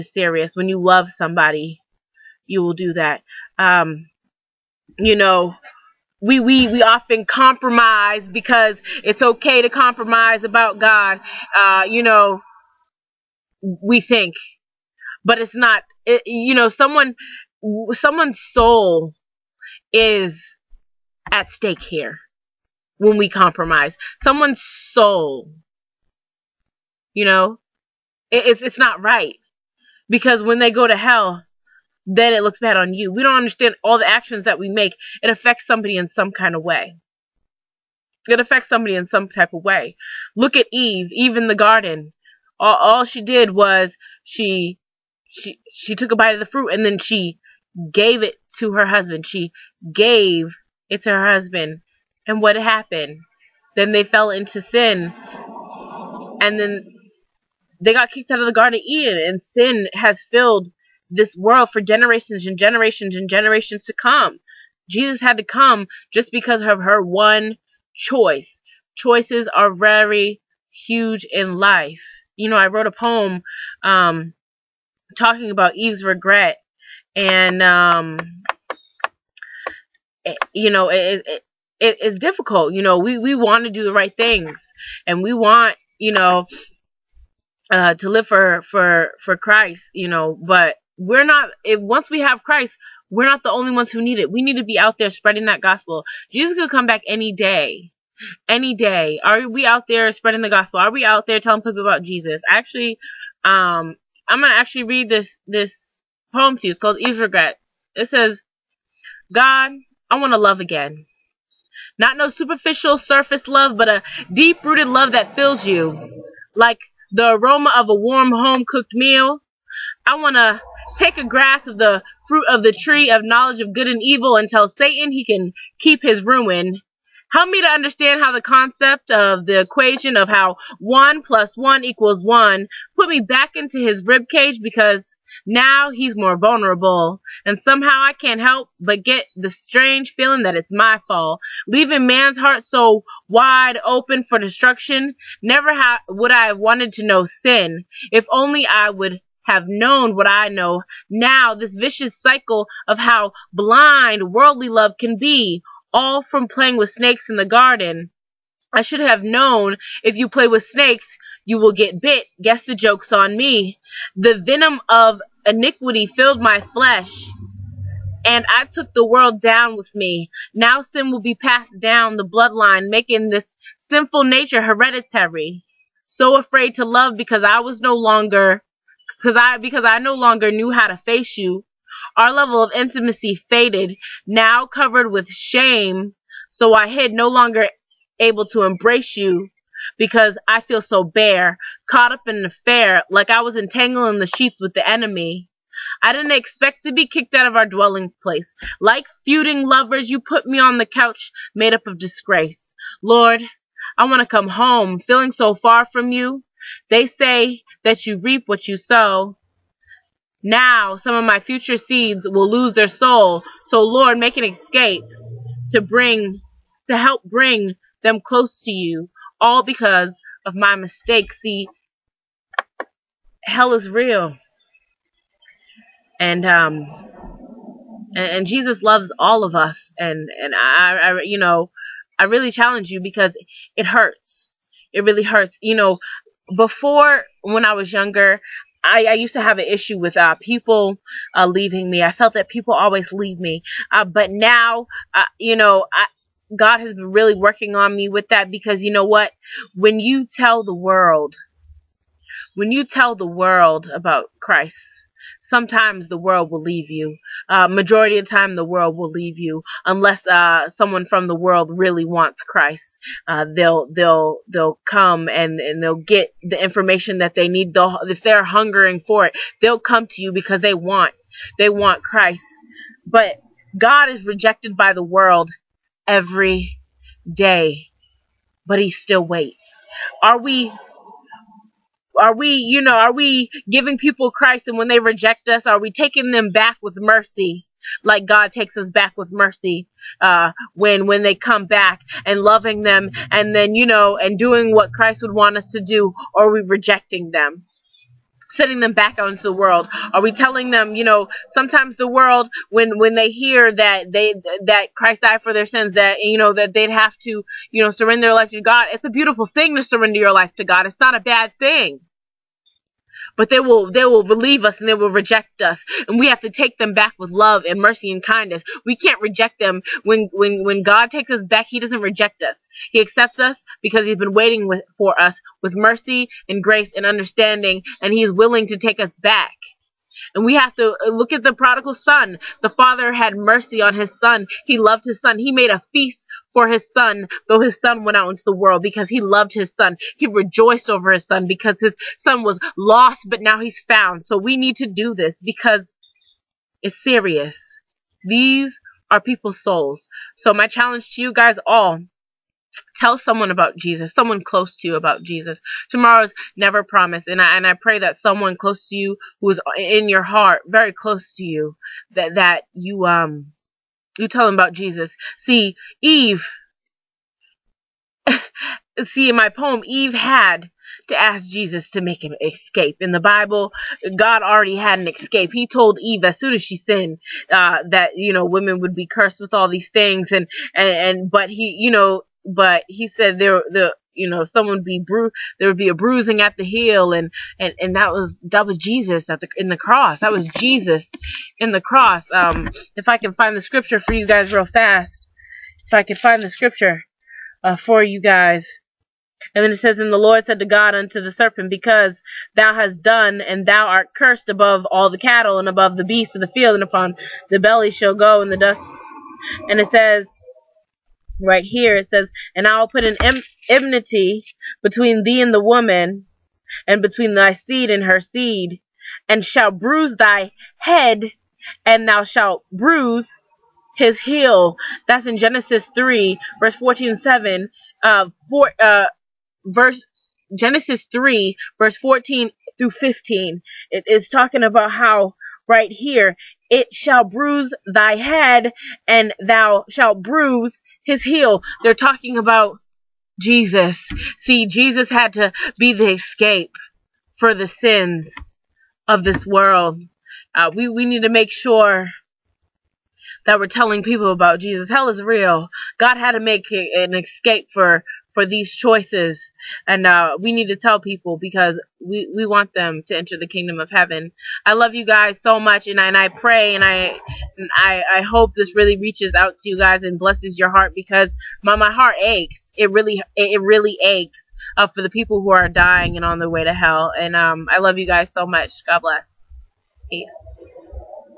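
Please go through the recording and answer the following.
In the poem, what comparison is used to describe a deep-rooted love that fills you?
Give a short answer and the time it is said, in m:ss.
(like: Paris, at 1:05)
A warm home cooked meal, at 1:57.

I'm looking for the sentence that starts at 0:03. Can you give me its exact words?
Um, you know, we, we, we often compromise because it's okay to compromise about God.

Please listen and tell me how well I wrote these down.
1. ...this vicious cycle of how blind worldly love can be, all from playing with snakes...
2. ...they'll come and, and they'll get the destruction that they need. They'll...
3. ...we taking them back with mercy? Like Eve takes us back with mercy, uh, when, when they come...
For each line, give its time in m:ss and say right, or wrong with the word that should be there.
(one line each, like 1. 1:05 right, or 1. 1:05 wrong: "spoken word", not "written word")
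1. 2:31 right
2. 4:24 wrong: "information", not "destruction"
3. 4:45 wrong: "God", not "Eve".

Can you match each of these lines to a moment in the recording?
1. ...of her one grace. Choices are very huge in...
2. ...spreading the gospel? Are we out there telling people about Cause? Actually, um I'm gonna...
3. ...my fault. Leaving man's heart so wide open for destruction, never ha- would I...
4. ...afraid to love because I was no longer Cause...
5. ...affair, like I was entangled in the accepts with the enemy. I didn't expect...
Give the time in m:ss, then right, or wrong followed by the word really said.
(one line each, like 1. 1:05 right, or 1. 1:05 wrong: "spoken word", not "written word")
1. 1:06 wrong: "choice", not "grace"
2. 1:40 wrong: "Jesus", not "Cause"
3. 2:20 right
4. 2:56 right
5. 3:12 wrong: "sheets", not "accepts".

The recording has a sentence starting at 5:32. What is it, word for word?
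The father had mercy on his son.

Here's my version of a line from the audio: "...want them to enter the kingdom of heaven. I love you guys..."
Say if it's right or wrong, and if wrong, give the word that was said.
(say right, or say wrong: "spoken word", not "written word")
right.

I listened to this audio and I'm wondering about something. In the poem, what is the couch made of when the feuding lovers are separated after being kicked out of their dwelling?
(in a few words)
Disgrace.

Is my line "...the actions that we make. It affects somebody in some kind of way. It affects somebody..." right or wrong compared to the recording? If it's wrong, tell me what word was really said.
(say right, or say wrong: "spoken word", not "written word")
right.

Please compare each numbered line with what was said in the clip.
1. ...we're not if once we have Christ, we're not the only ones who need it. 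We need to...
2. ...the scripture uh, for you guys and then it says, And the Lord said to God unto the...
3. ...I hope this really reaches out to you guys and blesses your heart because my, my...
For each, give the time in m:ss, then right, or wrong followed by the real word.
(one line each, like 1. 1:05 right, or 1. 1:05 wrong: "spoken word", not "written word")
1. 1:30 right
2. 6:36 right
3. 7:48 right.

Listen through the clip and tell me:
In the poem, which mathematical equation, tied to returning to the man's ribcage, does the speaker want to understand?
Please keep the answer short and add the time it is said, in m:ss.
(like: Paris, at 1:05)
1 plus 1 equals 1, at 2:10.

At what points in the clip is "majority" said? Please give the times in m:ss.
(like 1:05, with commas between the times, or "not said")
4:17.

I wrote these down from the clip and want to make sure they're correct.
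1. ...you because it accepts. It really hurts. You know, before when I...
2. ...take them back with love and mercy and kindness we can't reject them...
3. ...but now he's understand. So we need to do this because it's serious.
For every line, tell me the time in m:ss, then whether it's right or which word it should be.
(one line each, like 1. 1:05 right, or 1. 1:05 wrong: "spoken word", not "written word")
1. 3:52 wrong: "hurts", not "accepts"
2. 5:16 right
3. 5:43 wrong: "found", not "understand".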